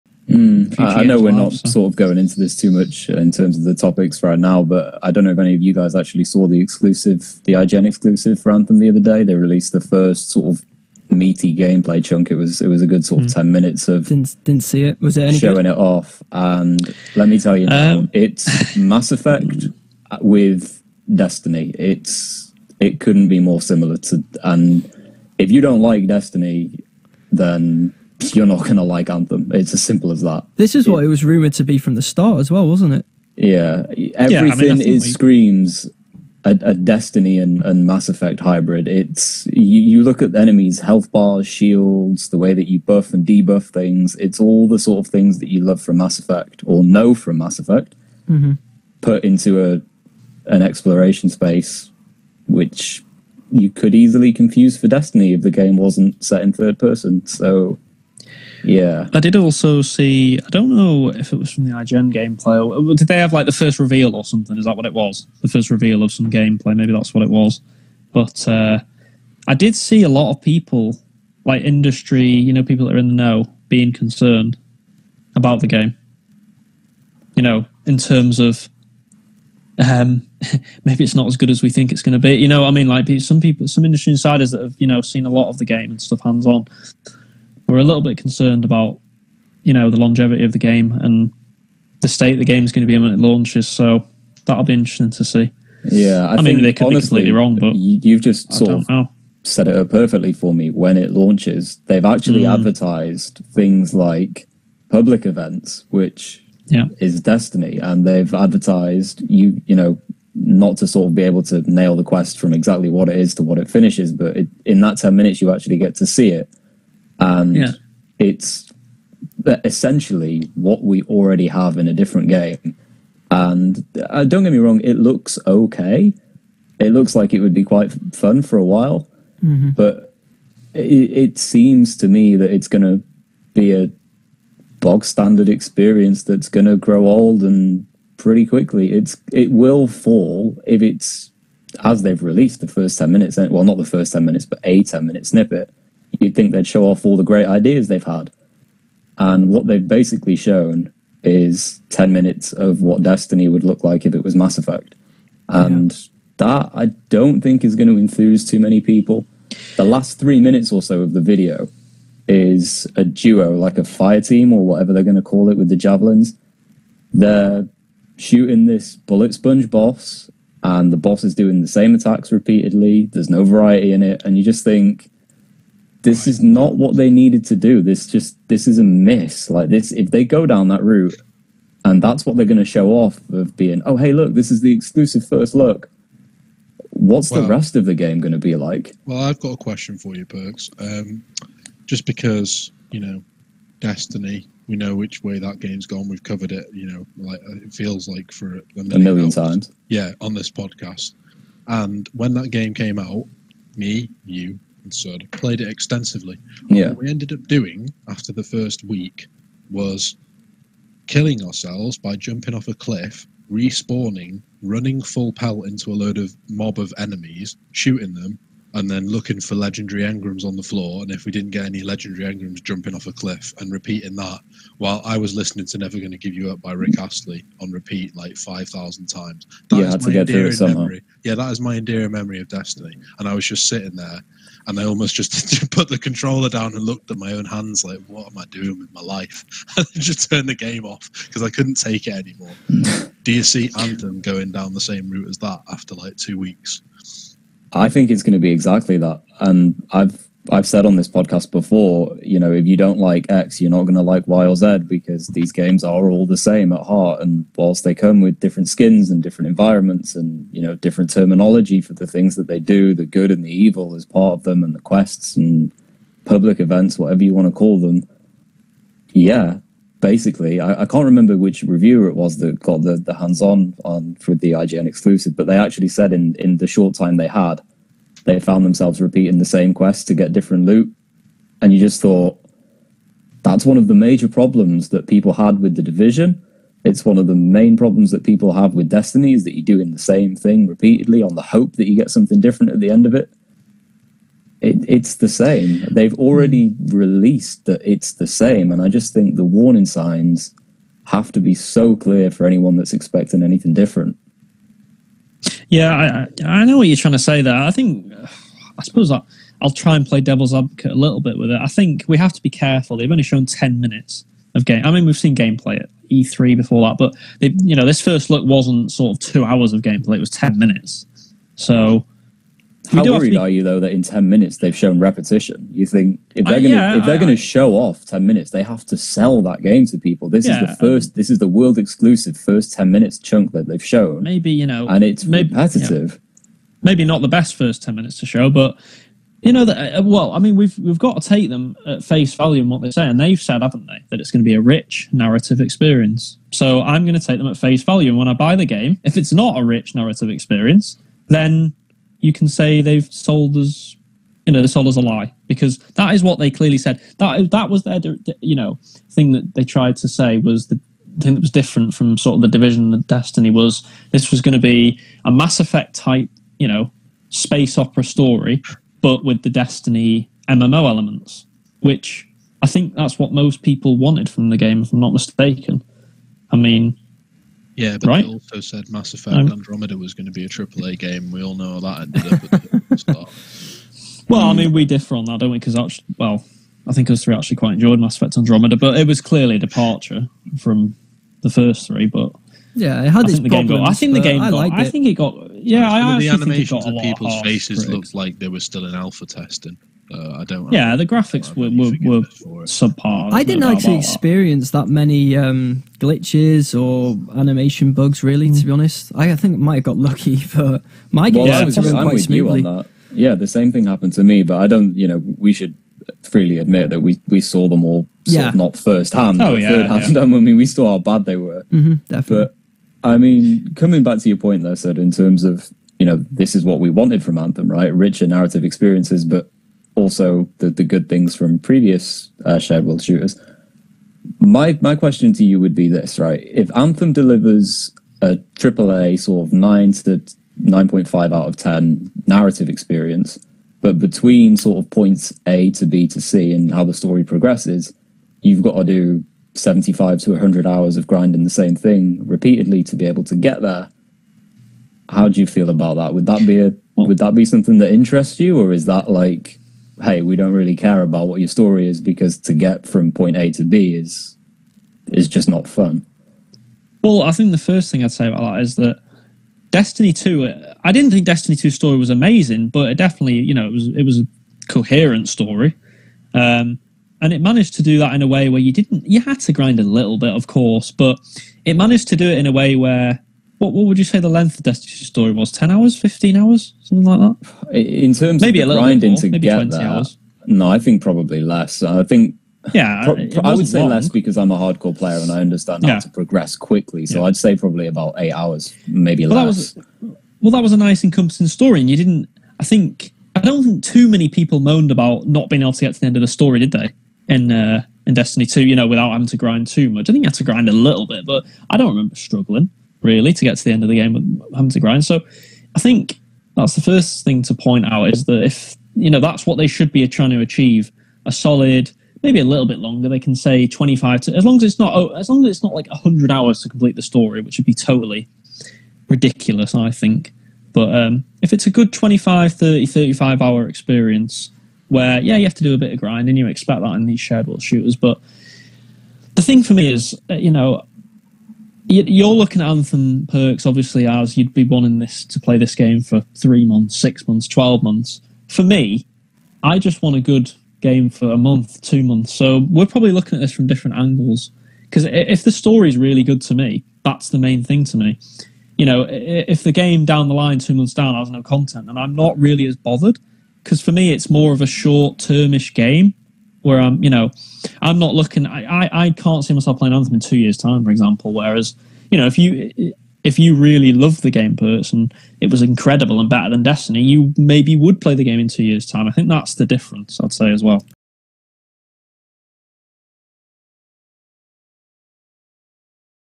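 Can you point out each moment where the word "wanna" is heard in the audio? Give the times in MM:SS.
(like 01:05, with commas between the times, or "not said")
not said.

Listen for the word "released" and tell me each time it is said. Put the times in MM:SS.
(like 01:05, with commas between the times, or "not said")
00:09, 02:22, 04:56.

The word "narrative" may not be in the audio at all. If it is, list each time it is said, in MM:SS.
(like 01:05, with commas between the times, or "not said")
05:45, 05:49, 07:08, 07:22.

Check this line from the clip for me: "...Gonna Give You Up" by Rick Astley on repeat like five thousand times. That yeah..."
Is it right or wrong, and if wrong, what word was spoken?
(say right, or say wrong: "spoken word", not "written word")
right.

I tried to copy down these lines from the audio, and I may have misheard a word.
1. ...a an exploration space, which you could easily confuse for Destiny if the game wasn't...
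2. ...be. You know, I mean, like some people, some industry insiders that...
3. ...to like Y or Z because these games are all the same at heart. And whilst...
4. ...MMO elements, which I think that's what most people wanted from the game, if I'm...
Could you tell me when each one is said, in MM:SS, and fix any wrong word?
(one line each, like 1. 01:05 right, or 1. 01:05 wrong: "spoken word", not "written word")
1. 00:49 right
2. 01:22 right
3. 04:13 right
4. 06:10 right.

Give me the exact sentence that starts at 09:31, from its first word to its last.
Whereas, you know, if you if you really love the game, person, it was incredible and better than Destiny.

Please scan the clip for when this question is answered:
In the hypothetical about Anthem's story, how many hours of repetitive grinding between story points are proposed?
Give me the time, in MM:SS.
07:29.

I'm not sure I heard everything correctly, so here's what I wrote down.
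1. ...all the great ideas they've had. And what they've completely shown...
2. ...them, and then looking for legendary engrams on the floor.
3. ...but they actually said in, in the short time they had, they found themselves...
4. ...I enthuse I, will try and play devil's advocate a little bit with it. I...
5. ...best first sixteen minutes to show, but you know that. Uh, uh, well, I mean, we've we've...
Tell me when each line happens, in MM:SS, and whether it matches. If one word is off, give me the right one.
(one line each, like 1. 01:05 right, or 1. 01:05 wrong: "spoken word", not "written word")
1. 02:27 wrong: "basically", not "completely"
2. 03:38 right
3. 04:35 right
4. 05:08 wrong: "suppose", not "enthuse"
5. 05:37 wrong: "ten", not "sixteen".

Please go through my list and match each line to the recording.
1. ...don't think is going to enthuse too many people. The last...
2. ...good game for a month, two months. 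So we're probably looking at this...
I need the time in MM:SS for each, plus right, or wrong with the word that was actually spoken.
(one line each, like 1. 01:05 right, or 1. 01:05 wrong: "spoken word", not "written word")
1. 02:37 right
2. 09:10 right.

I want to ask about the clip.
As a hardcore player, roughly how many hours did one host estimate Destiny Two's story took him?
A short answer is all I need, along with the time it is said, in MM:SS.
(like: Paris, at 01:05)
8 hours, at 08:17.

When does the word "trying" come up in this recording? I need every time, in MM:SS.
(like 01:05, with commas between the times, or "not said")
05:06, 08:40.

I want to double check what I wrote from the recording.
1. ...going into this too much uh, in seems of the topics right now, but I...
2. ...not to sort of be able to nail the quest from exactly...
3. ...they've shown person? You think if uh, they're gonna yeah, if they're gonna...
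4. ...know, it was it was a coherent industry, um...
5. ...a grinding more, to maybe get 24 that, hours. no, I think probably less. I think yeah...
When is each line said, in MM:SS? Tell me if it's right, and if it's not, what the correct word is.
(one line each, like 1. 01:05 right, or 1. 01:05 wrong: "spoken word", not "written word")
1. 00:01 wrong: "terms", not "seems"
2. 01:50 right
3. 05:24 wrong: "repetition", not "person"
4. 07:53 wrong: "story", not "industry"
5. 08:08 wrong: "20", not "24".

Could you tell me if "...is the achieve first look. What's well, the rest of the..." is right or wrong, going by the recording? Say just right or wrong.
wrong.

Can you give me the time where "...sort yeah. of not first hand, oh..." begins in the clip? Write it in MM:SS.
06:58.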